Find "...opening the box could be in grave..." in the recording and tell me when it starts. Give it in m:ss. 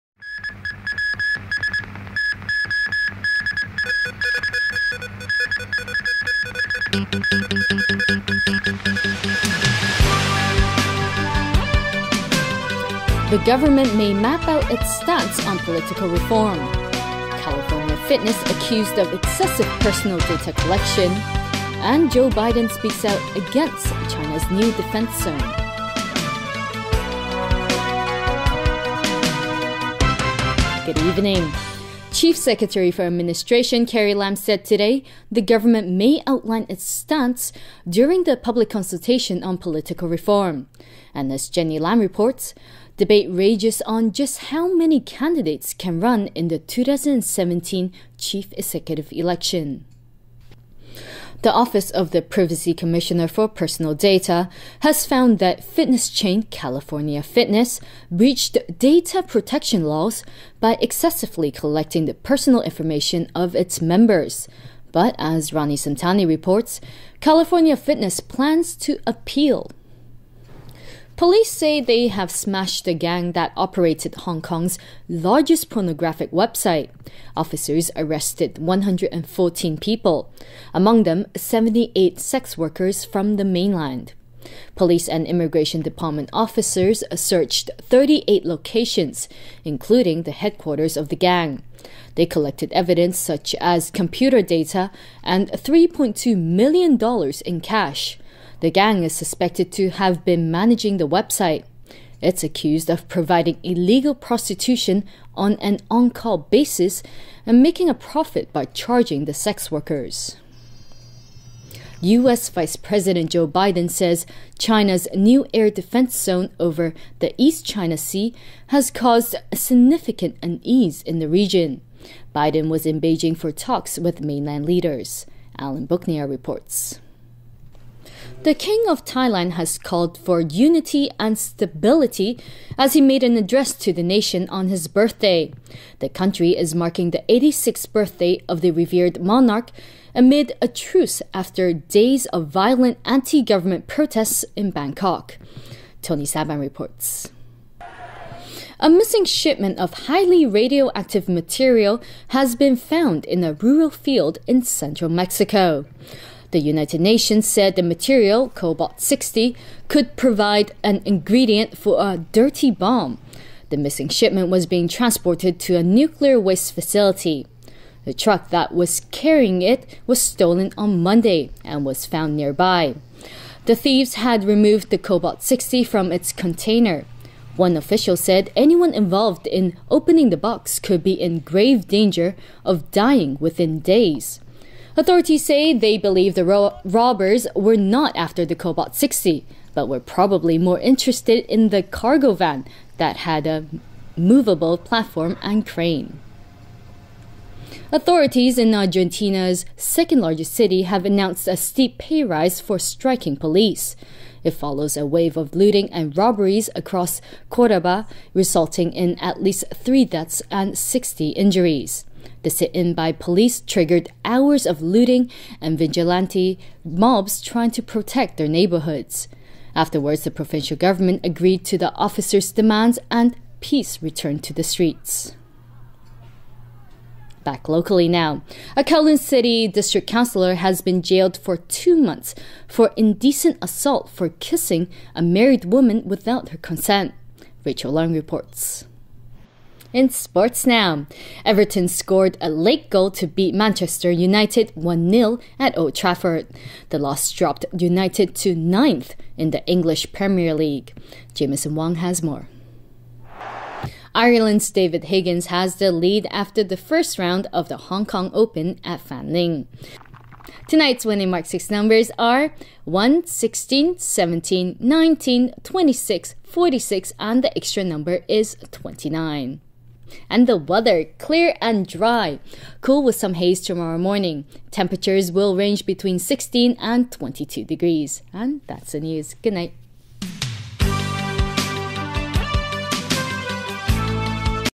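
2:59.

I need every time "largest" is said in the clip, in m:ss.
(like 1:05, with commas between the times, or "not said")
1:15, 3:20.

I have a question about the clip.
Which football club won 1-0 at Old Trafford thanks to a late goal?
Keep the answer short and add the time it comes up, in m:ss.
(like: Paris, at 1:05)
Everton, at 4:01.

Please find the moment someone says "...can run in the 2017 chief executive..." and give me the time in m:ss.
0:45.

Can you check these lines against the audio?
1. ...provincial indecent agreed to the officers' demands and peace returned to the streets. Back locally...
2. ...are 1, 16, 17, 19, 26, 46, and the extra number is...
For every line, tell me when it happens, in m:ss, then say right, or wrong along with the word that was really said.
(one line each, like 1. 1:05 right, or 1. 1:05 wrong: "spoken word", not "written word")
1. 3:40 wrong: "government", not "indecent"
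2. 4:22 right.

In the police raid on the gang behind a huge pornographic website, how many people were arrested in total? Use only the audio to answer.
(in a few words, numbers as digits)
114.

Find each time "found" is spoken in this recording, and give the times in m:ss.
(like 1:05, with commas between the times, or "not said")
0:55, 2:32, 2:52.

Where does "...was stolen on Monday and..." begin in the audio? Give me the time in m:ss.
2:50.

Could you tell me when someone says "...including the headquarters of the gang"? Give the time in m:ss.
1:29.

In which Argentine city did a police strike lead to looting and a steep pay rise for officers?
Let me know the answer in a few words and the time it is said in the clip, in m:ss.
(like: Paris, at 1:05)
Cordoba, at 3:27.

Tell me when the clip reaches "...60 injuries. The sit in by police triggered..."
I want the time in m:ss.
3:30.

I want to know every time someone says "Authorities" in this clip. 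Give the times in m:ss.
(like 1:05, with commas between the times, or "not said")
3:04, 3:17.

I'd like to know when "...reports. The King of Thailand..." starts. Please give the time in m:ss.
2:06.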